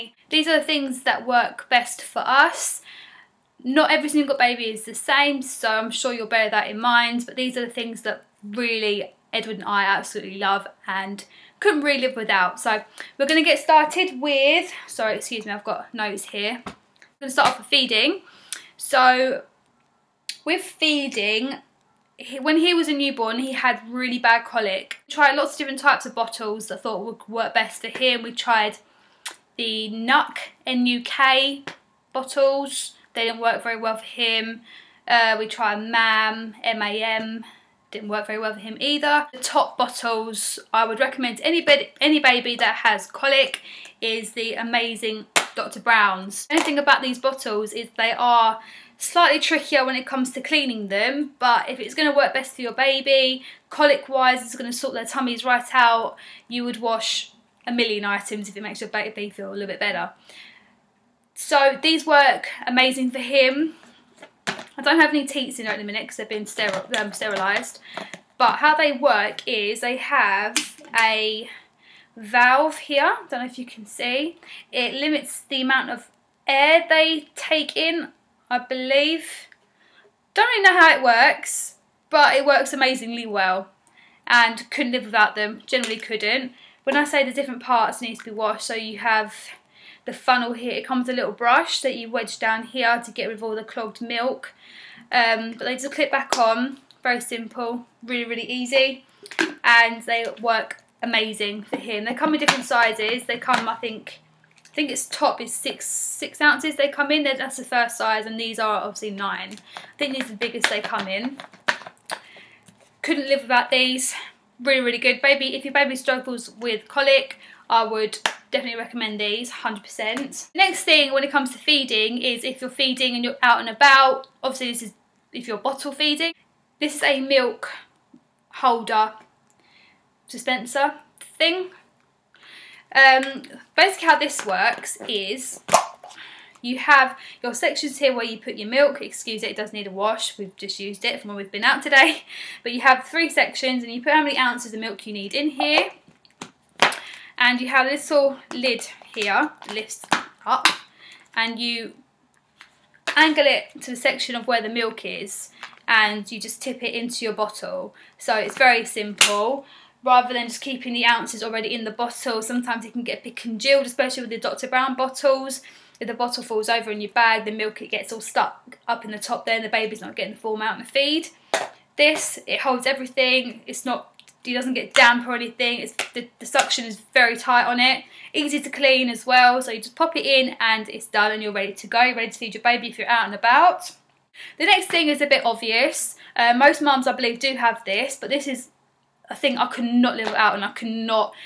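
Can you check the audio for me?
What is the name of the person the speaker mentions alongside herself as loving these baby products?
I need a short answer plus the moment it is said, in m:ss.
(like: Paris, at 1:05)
Edward, at 0:09.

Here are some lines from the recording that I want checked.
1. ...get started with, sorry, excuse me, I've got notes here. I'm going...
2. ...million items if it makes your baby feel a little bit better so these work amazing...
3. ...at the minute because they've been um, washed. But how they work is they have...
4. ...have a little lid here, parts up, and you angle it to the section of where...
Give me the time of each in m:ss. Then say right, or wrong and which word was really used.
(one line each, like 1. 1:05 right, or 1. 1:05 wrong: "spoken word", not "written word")
1. 0:13 right
2. 0:57 right
3. 1:05 wrong: "sterilised", not "washed"
4. 2:27 wrong: "lifts", not "parts".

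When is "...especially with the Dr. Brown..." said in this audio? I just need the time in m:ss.
2:43.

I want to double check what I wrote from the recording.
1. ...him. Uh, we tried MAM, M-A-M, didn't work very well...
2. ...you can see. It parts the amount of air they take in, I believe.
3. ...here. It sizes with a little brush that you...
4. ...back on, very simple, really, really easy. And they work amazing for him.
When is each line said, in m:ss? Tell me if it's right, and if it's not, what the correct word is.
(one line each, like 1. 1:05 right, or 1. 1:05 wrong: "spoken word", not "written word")
1. 0:34 right
2. 1:13 wrong: "limits", not "parts"
3. 1:30 wrong: "comes", not "sizes"
4. 1:36 right.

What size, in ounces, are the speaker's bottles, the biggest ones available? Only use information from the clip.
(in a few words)
9.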